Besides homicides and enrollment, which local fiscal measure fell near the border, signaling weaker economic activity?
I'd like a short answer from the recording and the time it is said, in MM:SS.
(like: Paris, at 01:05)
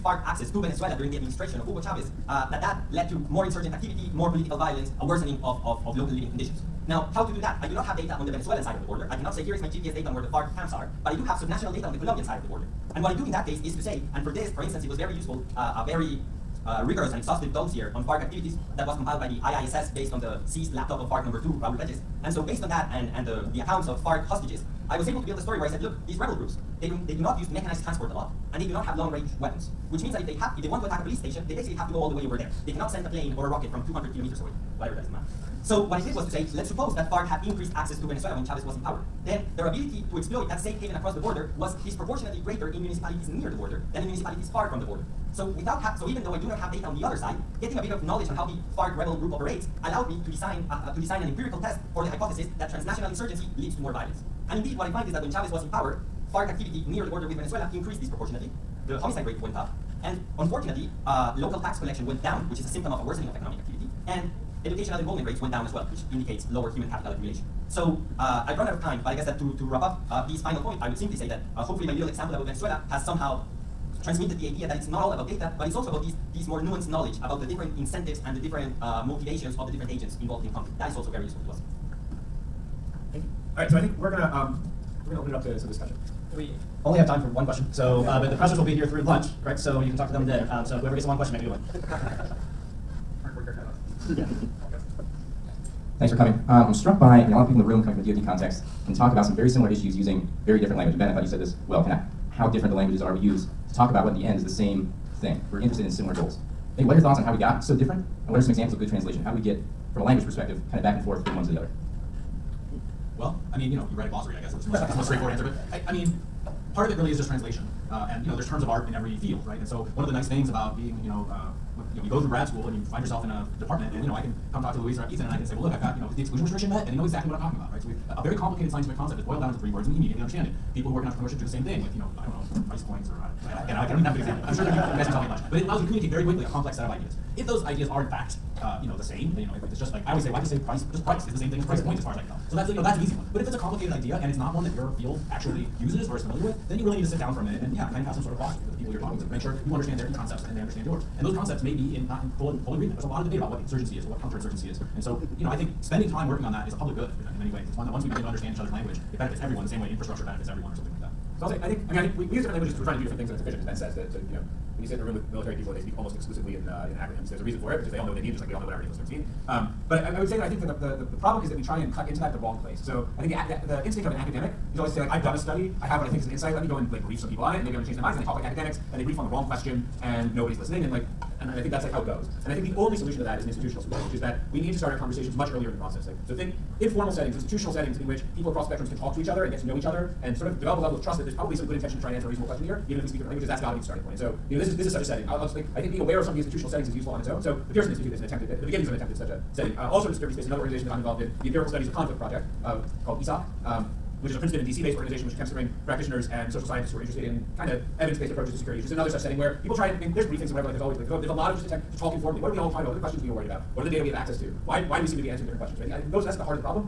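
local tax collection, at 01:01.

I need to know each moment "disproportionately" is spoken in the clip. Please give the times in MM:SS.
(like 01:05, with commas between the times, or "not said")
00:41, 00:58.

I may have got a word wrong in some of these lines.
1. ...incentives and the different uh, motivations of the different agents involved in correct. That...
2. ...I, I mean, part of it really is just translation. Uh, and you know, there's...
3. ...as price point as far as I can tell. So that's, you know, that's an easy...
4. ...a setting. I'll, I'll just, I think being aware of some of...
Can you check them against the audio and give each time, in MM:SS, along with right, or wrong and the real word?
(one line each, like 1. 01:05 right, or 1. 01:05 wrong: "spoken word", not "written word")
1. 01:17 wrong: "conflict", not "correct"
2. 01:55 right
3. 02:21 right
4. 03:15 right.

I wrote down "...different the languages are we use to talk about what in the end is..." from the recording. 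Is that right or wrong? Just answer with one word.
right.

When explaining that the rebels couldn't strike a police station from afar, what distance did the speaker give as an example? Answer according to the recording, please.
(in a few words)
200 kilometers.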